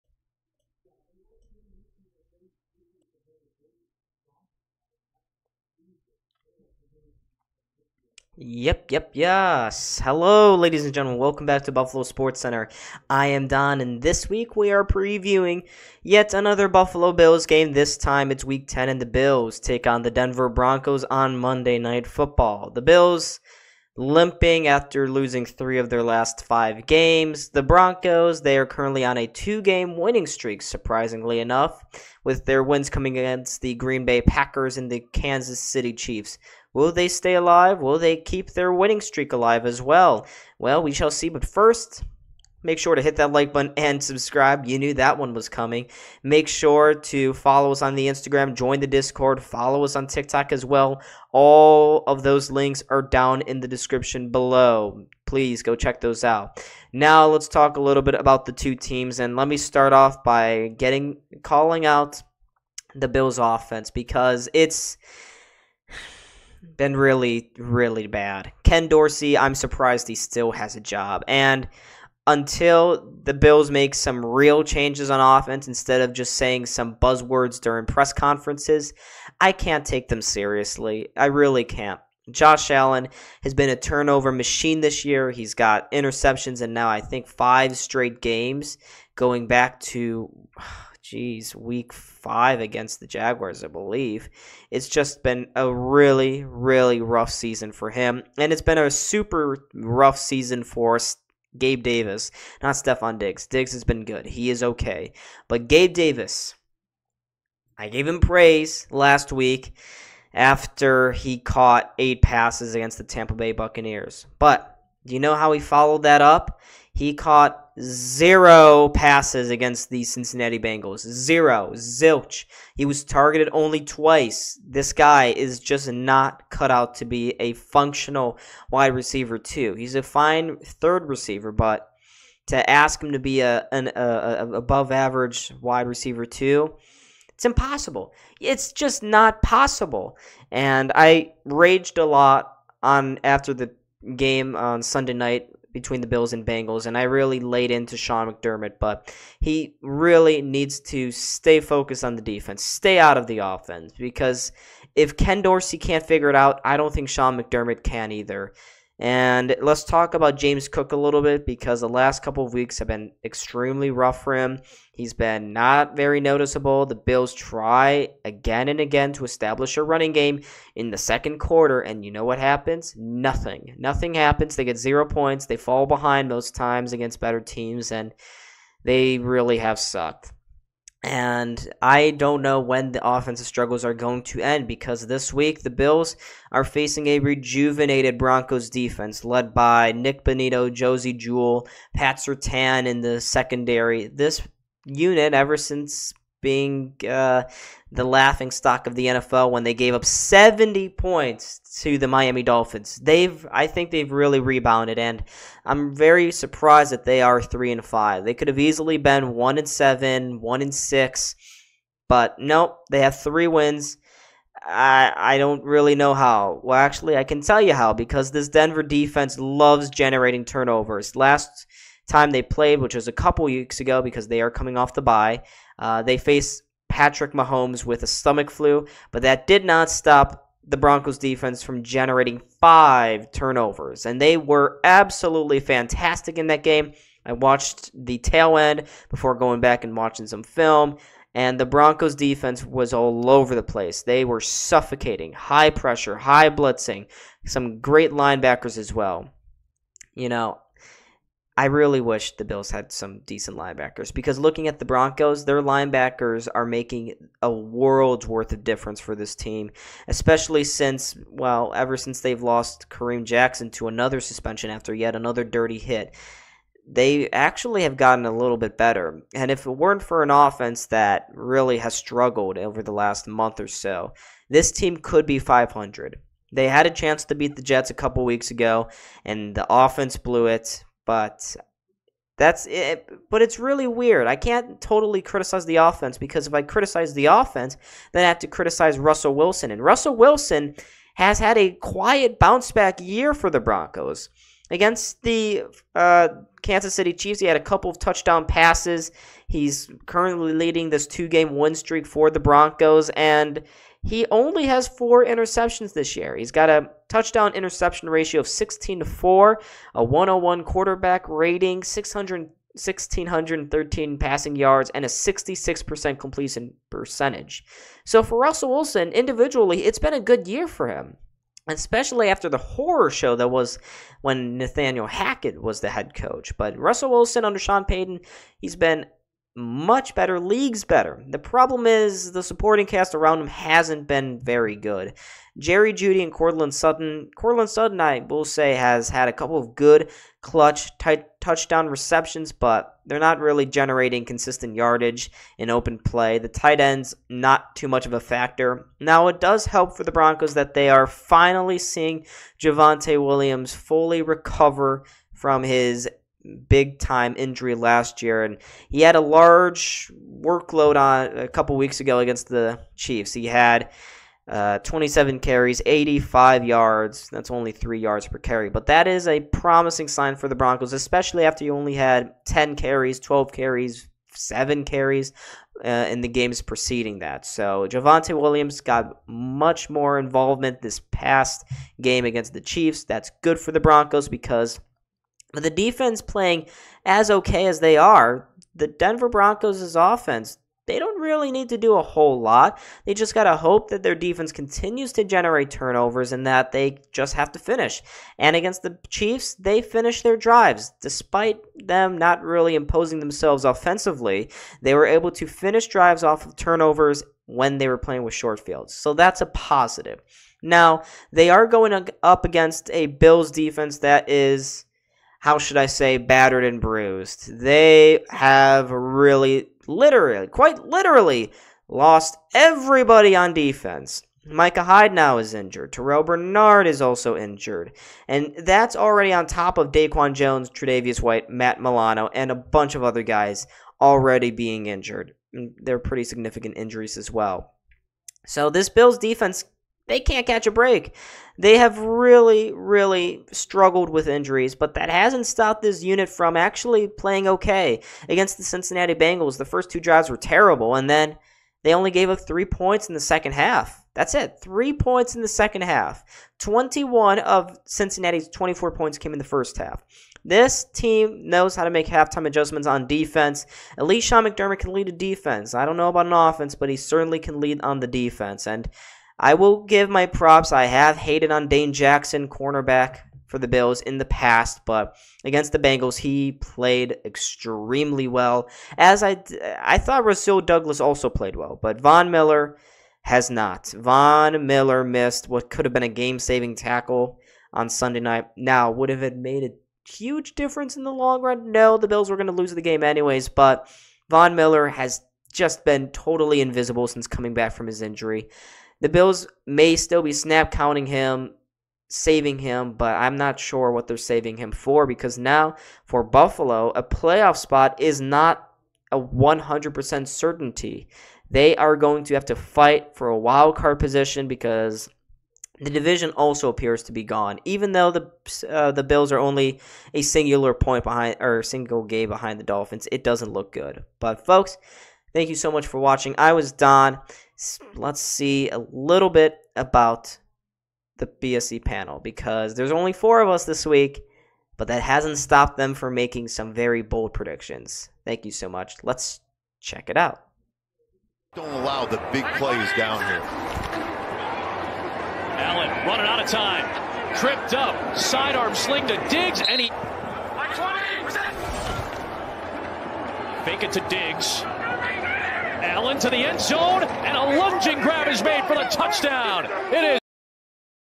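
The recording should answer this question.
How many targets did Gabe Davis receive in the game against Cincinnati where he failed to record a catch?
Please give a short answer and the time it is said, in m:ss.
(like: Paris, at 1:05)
2, at 2:03.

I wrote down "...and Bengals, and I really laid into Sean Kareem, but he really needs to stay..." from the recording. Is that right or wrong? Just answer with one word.
wrong.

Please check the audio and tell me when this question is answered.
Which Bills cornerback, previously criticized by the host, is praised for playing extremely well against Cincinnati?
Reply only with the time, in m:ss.
7:51.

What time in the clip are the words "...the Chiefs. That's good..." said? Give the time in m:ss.
6:22.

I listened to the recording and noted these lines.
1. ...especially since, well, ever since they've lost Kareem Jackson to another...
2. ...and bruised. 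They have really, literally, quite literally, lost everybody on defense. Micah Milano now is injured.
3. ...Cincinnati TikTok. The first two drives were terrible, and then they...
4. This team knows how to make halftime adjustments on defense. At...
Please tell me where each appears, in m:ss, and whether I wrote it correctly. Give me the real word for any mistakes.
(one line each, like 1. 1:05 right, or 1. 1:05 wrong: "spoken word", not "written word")
1. 4:20 right
2. 6:56 wrong: "Hyde", not "Milano"
3. 7:28 wrong: "Bengals", not "TikTok"
4. 7:40 right.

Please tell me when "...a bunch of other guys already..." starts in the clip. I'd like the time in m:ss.
7:12.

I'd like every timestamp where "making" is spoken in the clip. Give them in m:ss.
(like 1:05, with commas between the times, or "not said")
4:16, 8:56.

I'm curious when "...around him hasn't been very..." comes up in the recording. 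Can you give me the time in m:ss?
5:33.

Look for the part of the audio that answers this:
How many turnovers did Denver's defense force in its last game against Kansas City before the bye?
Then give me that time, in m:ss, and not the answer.
3:52.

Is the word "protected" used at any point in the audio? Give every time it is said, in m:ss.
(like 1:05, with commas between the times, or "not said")
not said.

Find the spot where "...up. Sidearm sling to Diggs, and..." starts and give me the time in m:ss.
9:07.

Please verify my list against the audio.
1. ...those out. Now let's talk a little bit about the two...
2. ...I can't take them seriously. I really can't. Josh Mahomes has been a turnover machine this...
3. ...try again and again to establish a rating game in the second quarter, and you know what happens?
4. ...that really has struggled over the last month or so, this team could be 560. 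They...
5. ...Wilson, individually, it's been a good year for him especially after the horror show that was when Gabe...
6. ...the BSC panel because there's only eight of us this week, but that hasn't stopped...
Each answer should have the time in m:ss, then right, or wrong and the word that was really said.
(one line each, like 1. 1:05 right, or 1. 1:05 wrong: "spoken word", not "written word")
1. 0:56 right
2. 1:19 wrong: "Allen", not "Mahomes"
3. 2:47 wrong: "running", not "rating"
4. 4:30 wrong: "500", not "560"
5. 5:18 wrong: "Nathaniel", not "Gabe"
6. 8:51 wrong: "four", not "eight".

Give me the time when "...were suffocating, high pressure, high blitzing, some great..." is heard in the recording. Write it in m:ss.
4:04.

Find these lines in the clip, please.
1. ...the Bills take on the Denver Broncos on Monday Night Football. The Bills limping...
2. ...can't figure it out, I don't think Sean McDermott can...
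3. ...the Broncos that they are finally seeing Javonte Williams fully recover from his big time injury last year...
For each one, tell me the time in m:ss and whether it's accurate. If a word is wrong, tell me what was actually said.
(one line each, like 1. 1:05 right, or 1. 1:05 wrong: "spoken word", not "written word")
1. 0:19 right
2. 2:35 right
3. 5:50 right.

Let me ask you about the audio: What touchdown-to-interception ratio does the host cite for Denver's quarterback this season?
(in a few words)
16 to 4.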